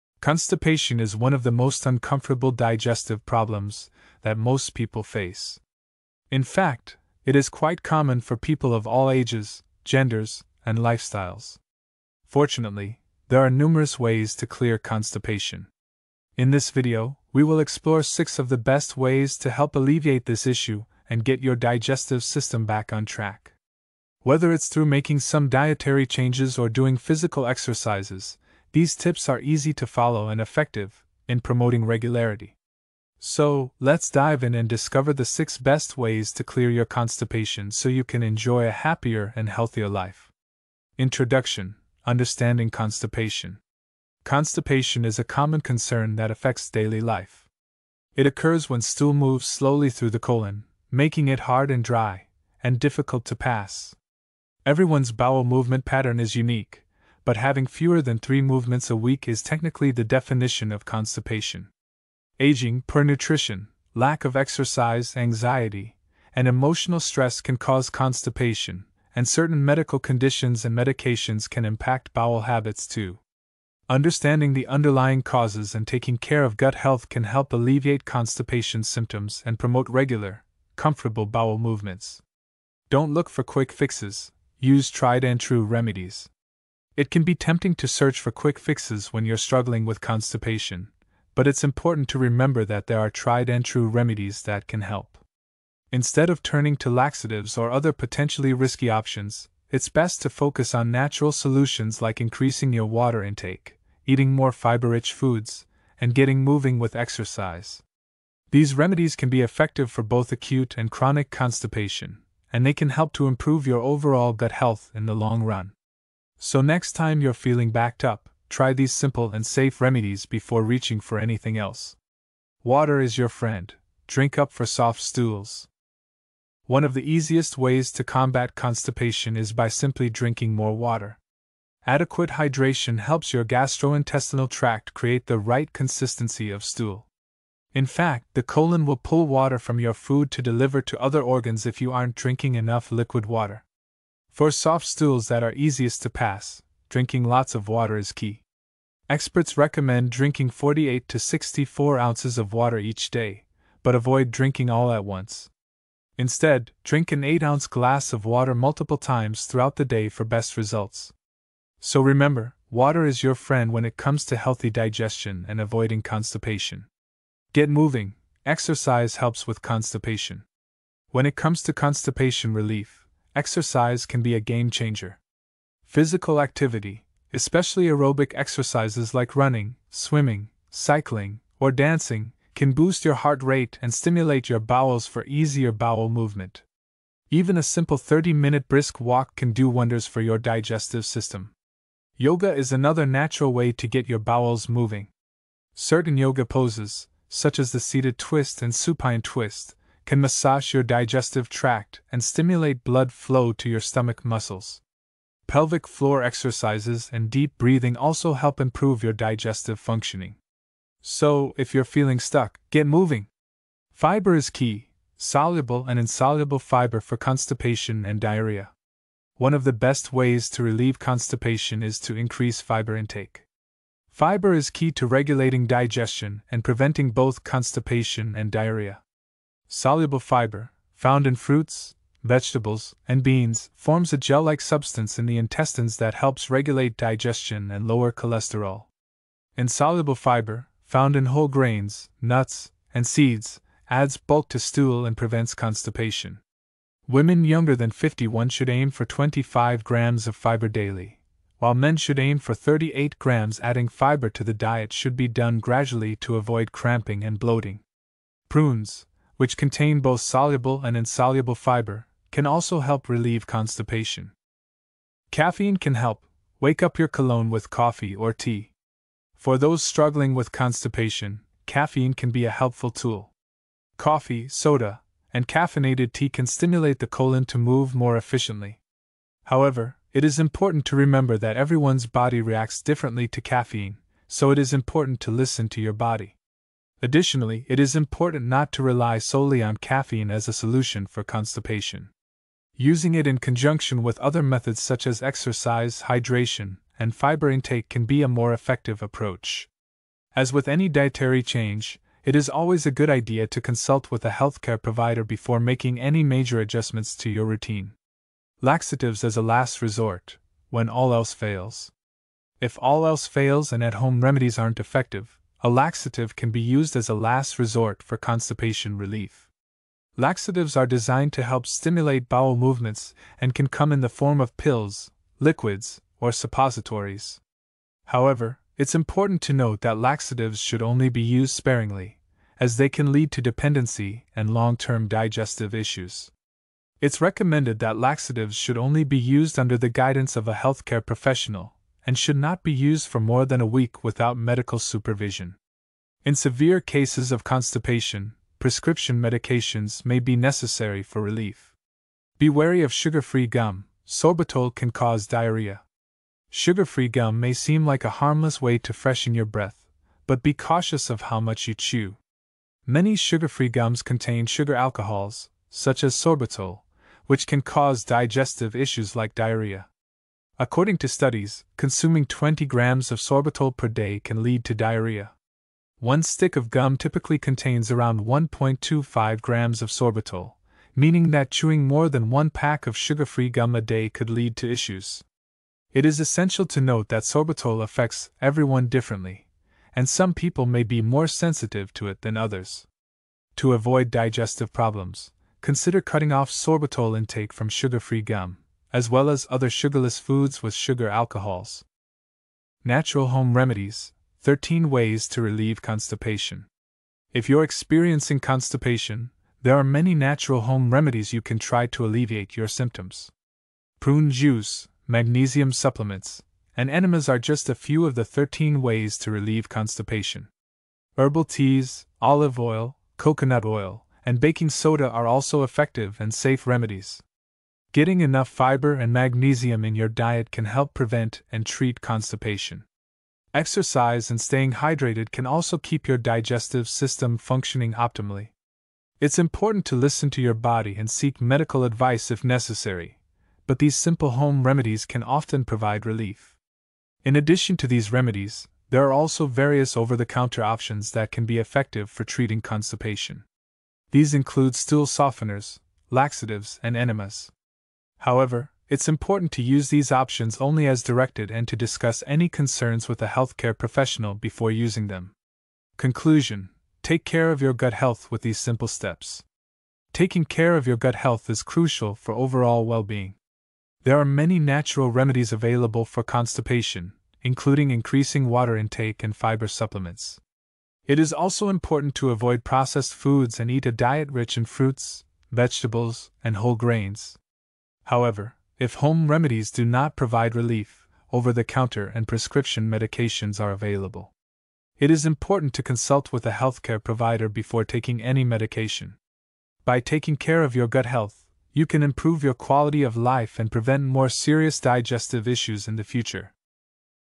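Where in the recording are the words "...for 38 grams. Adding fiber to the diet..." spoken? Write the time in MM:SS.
04:12.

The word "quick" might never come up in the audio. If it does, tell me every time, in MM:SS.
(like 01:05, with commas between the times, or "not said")
01:23, 01:28.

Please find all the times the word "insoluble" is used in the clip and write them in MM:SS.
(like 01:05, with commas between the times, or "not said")
03:35, 03:59, 04:20.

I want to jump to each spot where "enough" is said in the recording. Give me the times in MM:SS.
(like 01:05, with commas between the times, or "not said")
02:22, 07:08.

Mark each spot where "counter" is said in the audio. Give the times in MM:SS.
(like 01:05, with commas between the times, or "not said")
07:30, 08:11.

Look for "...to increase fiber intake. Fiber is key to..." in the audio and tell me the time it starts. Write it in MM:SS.
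03:42.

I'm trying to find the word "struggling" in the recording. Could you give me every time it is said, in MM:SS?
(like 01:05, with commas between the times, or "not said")
01:29, 04:29.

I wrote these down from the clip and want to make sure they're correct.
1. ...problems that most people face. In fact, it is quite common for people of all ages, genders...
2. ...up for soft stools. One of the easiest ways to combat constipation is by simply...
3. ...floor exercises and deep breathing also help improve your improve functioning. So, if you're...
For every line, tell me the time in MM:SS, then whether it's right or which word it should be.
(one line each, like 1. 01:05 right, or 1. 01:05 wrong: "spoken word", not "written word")
1. 00:03 right
2. 02:04 right
3. 03:25 wrong: "digestive", not "improve".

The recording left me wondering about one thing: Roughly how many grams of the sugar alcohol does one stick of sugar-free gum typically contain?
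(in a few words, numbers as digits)
1.25 grams.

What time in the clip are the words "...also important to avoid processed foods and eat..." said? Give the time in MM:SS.
08:01.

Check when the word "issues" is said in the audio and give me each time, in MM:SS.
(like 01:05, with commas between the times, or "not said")
00:20, 05:35, 06:08, 06:24, 08:25.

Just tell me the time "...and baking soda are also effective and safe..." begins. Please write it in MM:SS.
07:04.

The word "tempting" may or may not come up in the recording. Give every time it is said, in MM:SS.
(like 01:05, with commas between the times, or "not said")
01:27.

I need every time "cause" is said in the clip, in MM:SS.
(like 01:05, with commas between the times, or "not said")
01:07, 01:15, 05:54, 06:07.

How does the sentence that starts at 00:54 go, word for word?
Everyone's bowel movement pattern is unique, but having fewer than three movements a week is technically the definition of constipation.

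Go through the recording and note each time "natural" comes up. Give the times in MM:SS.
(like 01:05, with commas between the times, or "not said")
01:40, 03:13, 06:42, 06:50, 07:54.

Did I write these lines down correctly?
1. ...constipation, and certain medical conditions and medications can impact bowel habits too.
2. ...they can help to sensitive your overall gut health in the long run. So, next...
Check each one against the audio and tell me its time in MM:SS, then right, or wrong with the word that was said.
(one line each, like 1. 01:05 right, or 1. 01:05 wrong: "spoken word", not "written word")
1. 01:07 right
2. 01:52 wrong: "improve", not "sensitive".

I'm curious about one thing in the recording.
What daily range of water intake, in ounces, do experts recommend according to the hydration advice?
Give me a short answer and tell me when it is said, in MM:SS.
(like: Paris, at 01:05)
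48 to 64 ounces, at 02:30.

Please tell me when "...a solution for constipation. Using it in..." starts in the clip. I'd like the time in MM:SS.
04:50.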